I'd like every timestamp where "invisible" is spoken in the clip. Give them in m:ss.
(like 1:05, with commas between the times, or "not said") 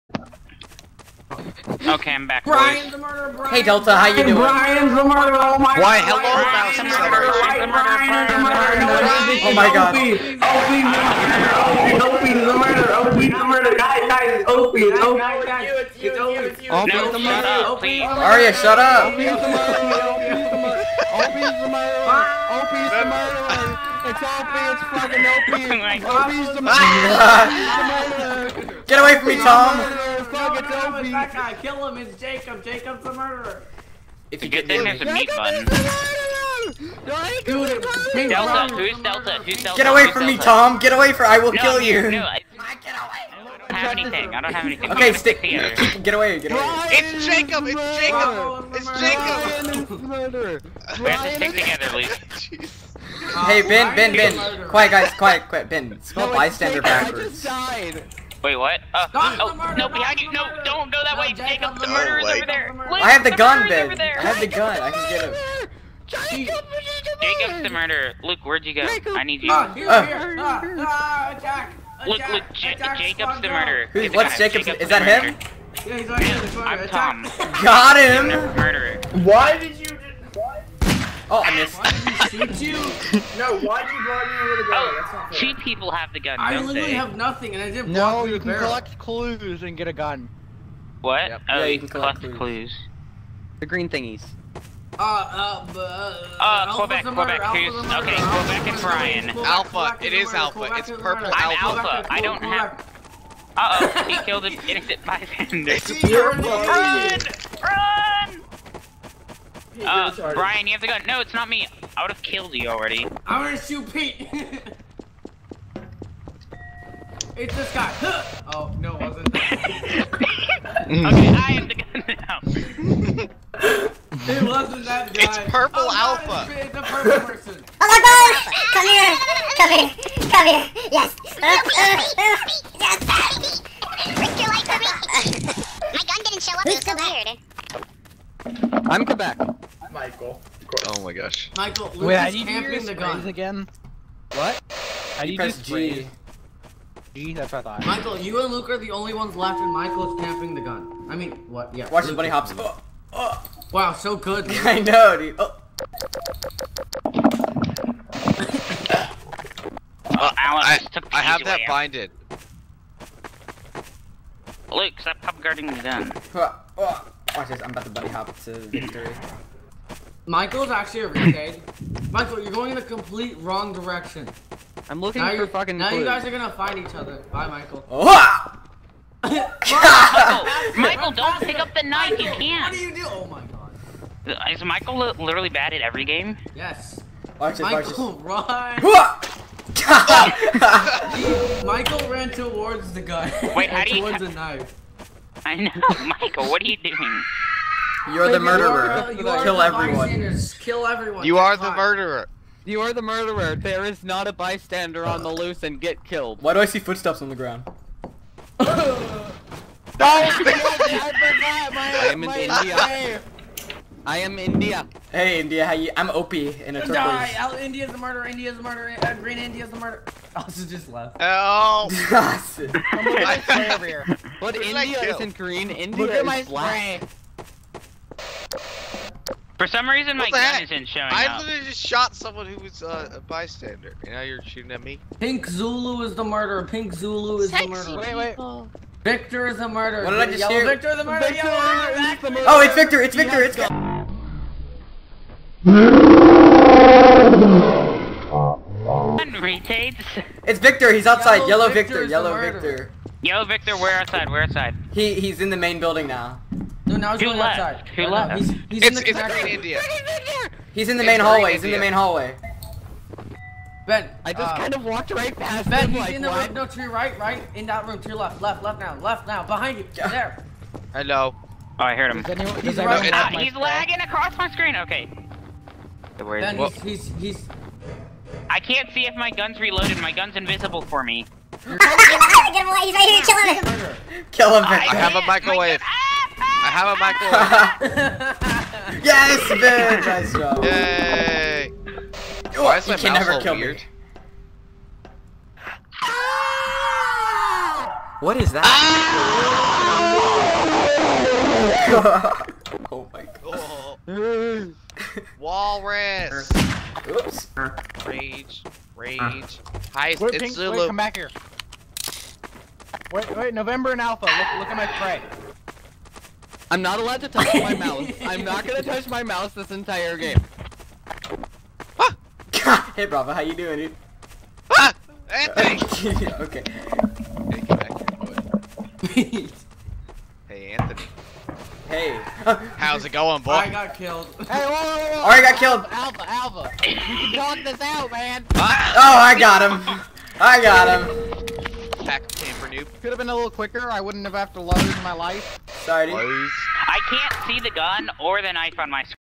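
4:40.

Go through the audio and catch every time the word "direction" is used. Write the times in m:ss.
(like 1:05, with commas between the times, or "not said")
2:53.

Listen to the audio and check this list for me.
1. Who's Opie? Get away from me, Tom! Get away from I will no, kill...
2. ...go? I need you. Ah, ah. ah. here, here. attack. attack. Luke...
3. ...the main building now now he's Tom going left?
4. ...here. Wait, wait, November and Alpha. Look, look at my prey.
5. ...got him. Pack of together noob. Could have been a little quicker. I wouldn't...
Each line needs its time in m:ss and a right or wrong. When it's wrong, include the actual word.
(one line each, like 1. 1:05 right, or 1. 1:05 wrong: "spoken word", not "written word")
1. 0:39 wrong: "Delta", not "Opie"
2. 1:08 right
3. 4:15 wrong: "Who", not "Tom"
4. 5:11 right
5. 5:40 wrong: "camper", not "together".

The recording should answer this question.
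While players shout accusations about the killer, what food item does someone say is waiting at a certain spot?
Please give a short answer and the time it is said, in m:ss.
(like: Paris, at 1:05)
meat bun, at 0:35.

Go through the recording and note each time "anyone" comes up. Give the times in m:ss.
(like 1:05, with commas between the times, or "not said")
4:32.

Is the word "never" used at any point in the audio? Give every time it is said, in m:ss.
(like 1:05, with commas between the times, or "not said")
4:53.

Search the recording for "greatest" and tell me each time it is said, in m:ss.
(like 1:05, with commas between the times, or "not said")
not said.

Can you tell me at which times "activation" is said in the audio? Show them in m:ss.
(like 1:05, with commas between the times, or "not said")
not said.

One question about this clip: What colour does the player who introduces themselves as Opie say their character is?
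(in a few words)
turquoise.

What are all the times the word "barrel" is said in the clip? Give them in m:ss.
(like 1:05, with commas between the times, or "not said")
1:28.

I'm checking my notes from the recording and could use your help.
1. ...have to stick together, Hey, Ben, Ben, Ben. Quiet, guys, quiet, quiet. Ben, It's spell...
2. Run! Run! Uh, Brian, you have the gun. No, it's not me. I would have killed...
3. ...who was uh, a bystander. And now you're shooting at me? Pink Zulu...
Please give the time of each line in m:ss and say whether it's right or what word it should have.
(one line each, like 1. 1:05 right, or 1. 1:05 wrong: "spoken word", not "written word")
1. 0:51 right
2. 1:46 right
3. 3:52 right.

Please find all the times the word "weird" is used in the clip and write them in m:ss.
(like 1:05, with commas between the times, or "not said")
2:18, 4:53.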